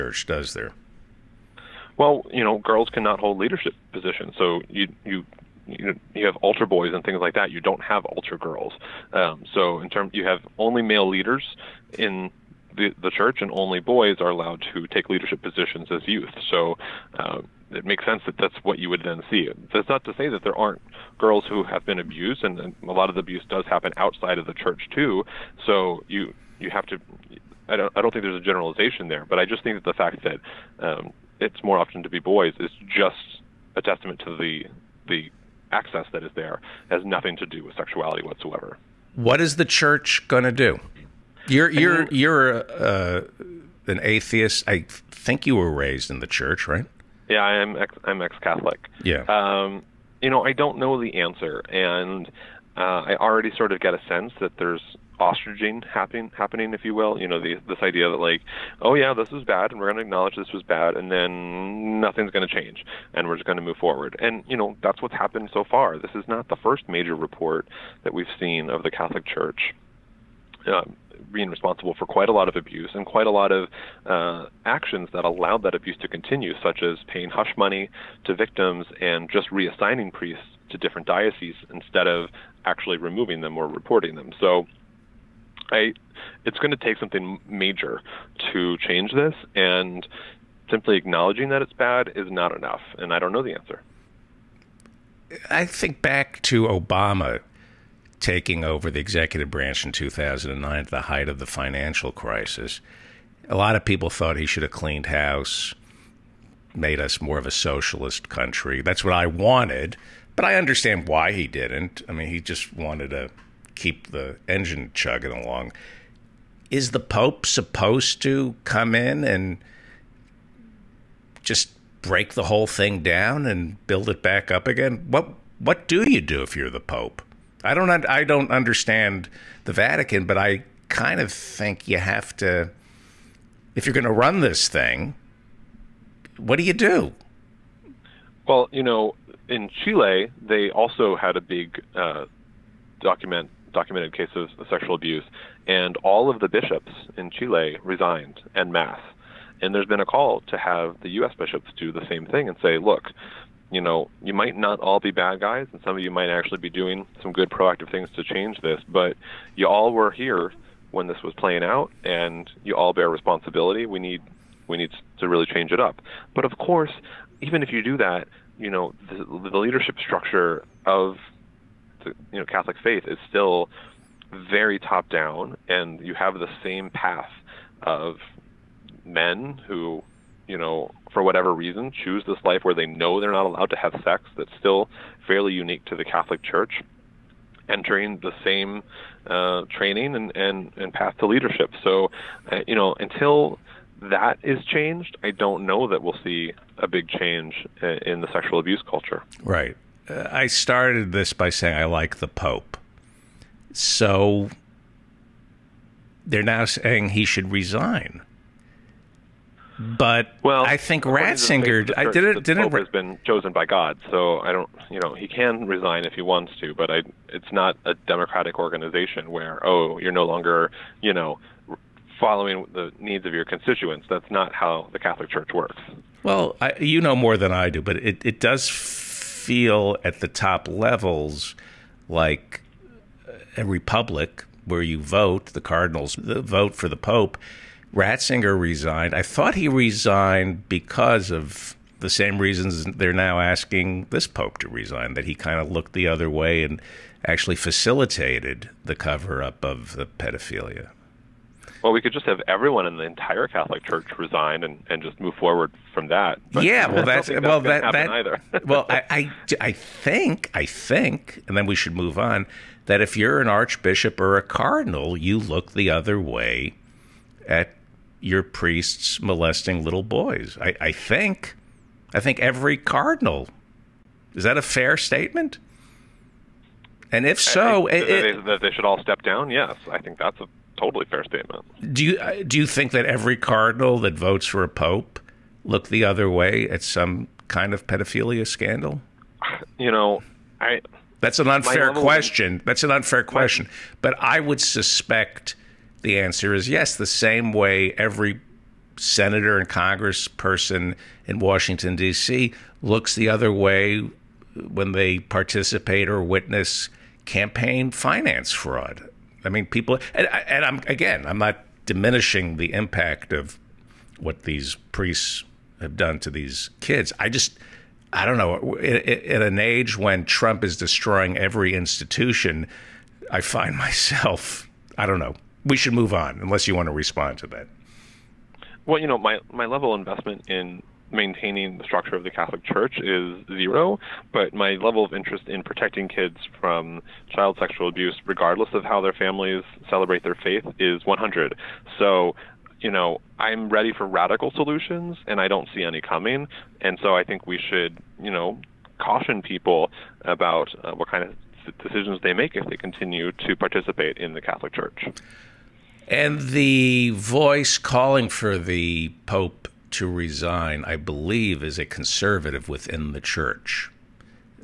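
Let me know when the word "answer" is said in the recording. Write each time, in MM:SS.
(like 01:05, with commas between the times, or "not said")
00:51, 01:33, 04:56.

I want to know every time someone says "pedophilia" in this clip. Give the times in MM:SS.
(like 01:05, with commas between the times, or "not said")
04:10, 04:47.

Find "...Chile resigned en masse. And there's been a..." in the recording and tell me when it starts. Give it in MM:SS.
02:27.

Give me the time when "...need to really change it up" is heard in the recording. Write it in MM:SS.
02:44.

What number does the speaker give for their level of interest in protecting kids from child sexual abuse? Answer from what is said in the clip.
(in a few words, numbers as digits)
100.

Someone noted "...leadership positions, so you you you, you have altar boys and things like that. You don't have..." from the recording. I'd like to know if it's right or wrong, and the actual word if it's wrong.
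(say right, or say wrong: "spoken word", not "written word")
right.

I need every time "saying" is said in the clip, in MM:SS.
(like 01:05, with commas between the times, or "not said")
03:21, 03:26.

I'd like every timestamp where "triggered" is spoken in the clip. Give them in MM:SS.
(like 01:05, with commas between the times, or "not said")
not said.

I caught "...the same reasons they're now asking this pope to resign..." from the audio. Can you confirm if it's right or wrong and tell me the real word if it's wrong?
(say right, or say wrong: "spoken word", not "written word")
right.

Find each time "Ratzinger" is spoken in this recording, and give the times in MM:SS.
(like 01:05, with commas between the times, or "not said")
03:31, 03:57.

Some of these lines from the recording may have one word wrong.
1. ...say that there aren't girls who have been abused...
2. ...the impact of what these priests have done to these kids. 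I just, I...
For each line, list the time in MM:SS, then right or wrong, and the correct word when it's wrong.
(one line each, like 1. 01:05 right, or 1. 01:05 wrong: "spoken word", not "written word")
1. 00:20 right
2. 05:12 right.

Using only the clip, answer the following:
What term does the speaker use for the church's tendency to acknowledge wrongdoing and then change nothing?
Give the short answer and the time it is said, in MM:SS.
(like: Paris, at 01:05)
Ostriching, at 00:55.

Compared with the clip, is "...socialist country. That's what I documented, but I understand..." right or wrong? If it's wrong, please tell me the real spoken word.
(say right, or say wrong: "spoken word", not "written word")
wrong: "wanted", not "documented".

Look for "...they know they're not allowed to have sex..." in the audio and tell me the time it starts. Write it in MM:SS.
03:02.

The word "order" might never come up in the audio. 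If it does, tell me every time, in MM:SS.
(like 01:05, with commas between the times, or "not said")
not said.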